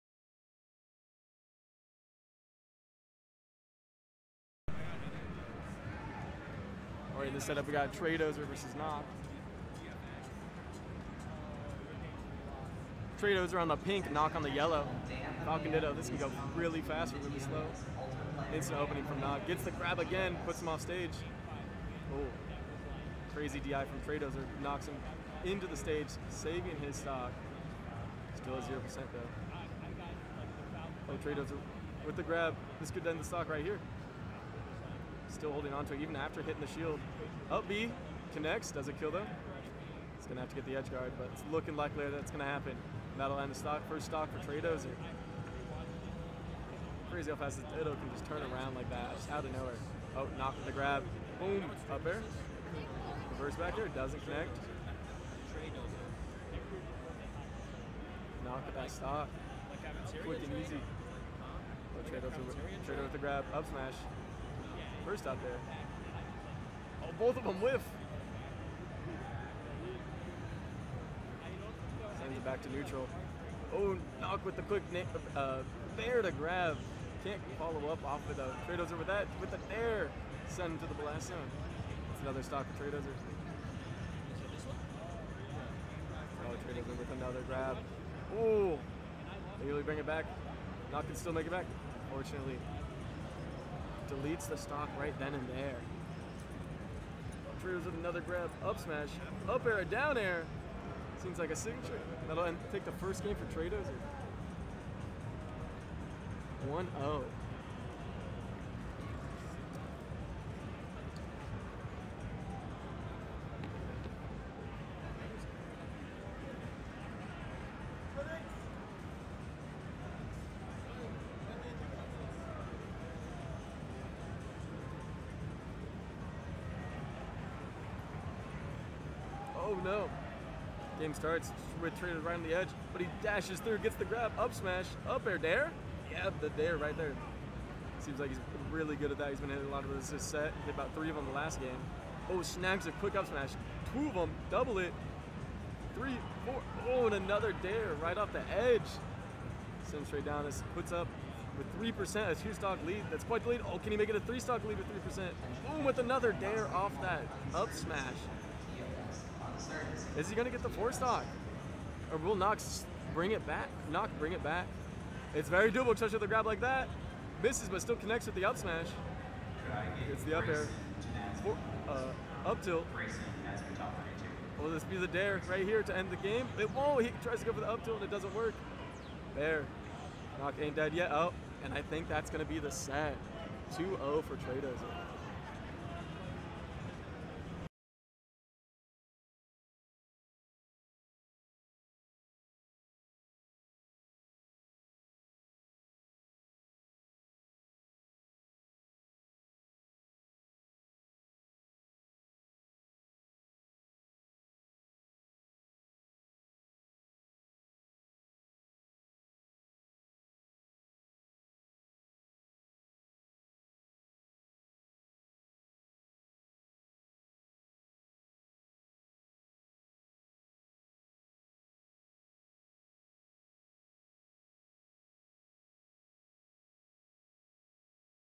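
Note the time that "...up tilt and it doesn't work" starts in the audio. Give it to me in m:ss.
2:57.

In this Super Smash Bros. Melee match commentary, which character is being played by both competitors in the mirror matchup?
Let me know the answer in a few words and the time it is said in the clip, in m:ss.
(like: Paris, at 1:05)
Falcon, at 0:15.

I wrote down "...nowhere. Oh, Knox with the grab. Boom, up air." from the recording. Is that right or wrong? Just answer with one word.
wrong.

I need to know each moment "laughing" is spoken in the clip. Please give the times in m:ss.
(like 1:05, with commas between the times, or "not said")
not said.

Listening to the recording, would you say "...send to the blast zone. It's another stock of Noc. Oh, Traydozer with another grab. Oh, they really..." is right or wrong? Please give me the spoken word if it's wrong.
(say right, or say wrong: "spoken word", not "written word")
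wrong: "Traydozer", not "Noc".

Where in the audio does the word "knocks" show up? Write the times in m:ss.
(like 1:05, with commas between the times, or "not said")
0:24, 2:40.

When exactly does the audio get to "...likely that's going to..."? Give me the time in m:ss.
0:41.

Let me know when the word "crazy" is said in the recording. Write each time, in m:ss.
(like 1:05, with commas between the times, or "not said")
0:23, 0:47.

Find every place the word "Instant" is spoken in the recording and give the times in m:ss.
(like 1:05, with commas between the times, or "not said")
0:18.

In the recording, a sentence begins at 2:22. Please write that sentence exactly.
Oh, snags a quick up smash.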